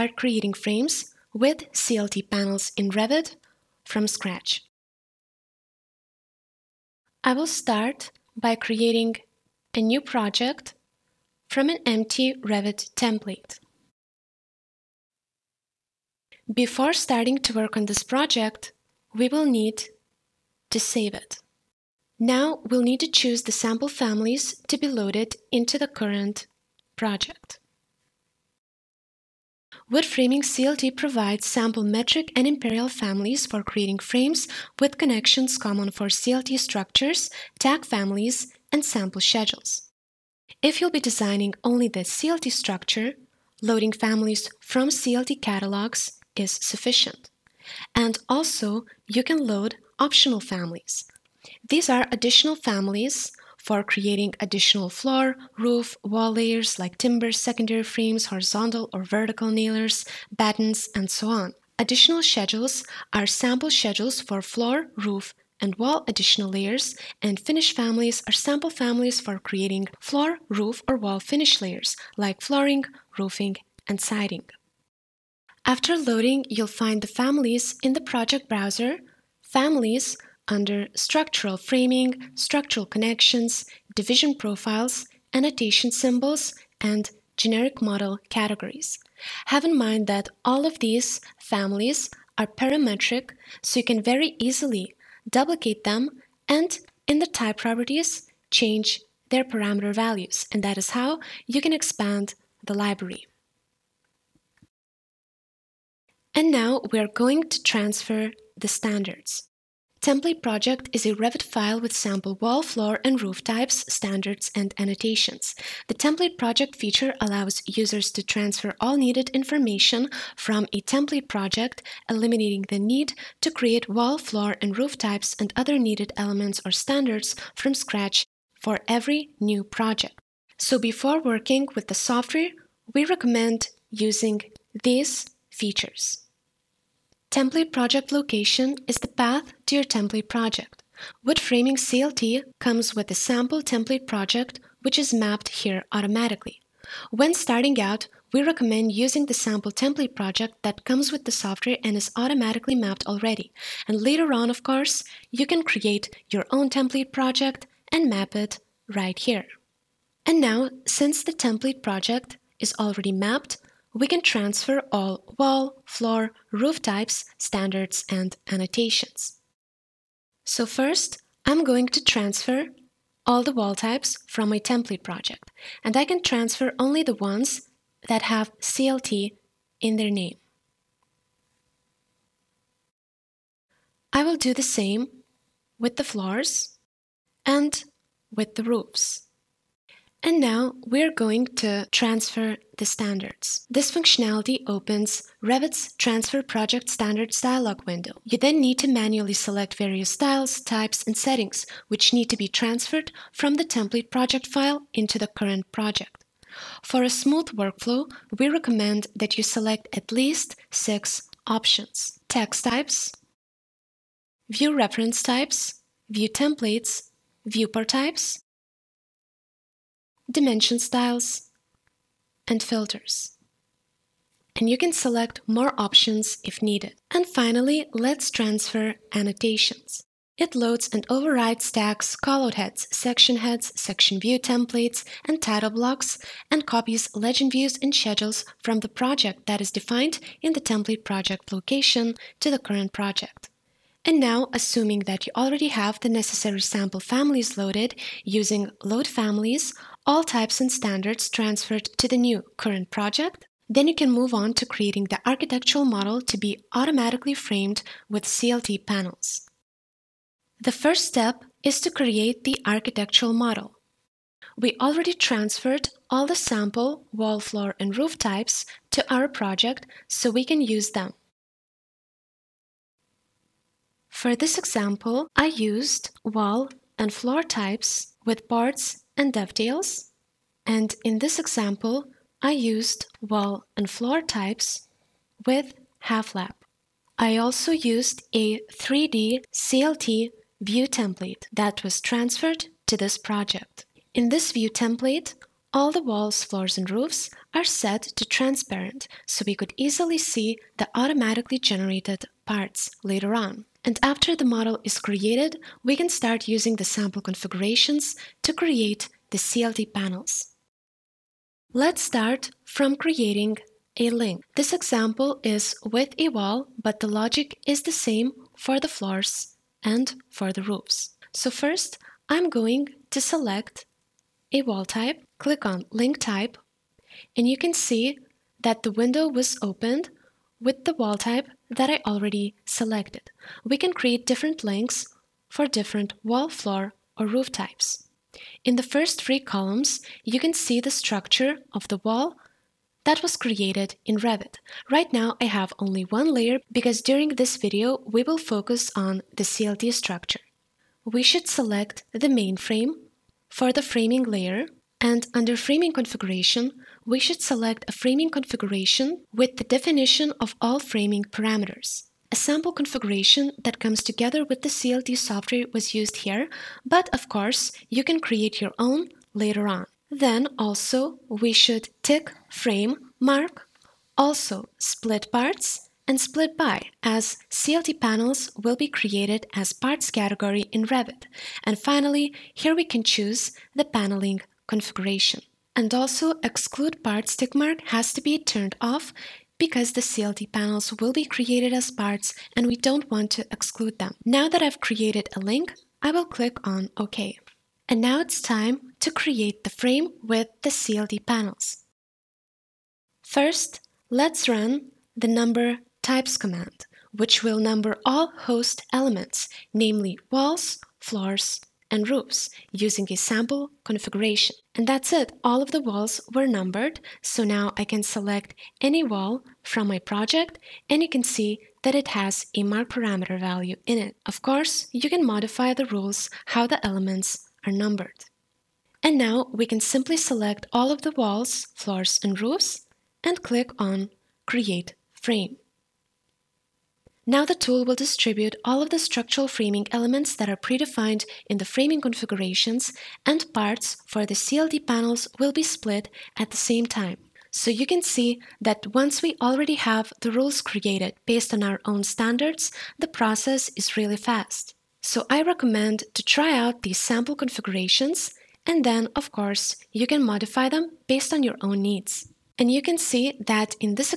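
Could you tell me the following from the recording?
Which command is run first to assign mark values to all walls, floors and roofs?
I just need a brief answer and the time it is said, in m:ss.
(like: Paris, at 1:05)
Number types, at 6:45.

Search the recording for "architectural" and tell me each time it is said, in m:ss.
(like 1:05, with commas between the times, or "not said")
4:15, 4:22.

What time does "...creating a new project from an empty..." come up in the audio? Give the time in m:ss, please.
0:08.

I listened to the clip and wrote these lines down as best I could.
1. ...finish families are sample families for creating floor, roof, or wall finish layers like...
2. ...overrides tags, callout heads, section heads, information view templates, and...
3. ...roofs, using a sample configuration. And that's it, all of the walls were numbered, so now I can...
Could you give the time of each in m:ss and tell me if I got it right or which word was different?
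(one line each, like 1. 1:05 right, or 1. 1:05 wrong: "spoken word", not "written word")
1. 1:07 right
2. 3:51 wrong: "section", not "information"
3. 6:52 right.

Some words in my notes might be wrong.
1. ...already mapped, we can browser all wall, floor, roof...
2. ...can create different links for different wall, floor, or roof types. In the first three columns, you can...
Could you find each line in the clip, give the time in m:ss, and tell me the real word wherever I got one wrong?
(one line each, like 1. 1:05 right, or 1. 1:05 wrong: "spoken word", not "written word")
1. 2:42 wrong: "transfer", not "browser"
2. 5:33 right.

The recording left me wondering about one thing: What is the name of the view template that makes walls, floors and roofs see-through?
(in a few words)
3D CLT.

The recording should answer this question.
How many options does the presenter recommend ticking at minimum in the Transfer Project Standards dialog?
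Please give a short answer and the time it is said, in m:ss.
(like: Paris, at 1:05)
6, at 3:30.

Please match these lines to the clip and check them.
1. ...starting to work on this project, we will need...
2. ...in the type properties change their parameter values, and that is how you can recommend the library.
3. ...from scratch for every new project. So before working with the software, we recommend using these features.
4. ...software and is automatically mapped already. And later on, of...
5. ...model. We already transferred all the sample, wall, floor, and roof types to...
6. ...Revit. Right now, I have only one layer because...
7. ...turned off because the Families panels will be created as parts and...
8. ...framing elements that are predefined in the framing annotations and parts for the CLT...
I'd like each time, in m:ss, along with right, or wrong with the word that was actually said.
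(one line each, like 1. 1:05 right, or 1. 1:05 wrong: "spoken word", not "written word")
1. 0:16 right
2. 1:37 wrong: "expand", not "recommend"
3. 2:07 right
4. 2:31 right
5. 4:23 right
6. 5:44 right
7. 6:28 wrong: "CLT", not "Families"
8. 7:19 wrong: "configurations", not "annotations".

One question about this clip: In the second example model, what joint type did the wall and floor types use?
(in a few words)
Half lap.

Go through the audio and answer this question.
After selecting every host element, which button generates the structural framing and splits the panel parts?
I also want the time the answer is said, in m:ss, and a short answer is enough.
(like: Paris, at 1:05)
Create Frame, at 7:14.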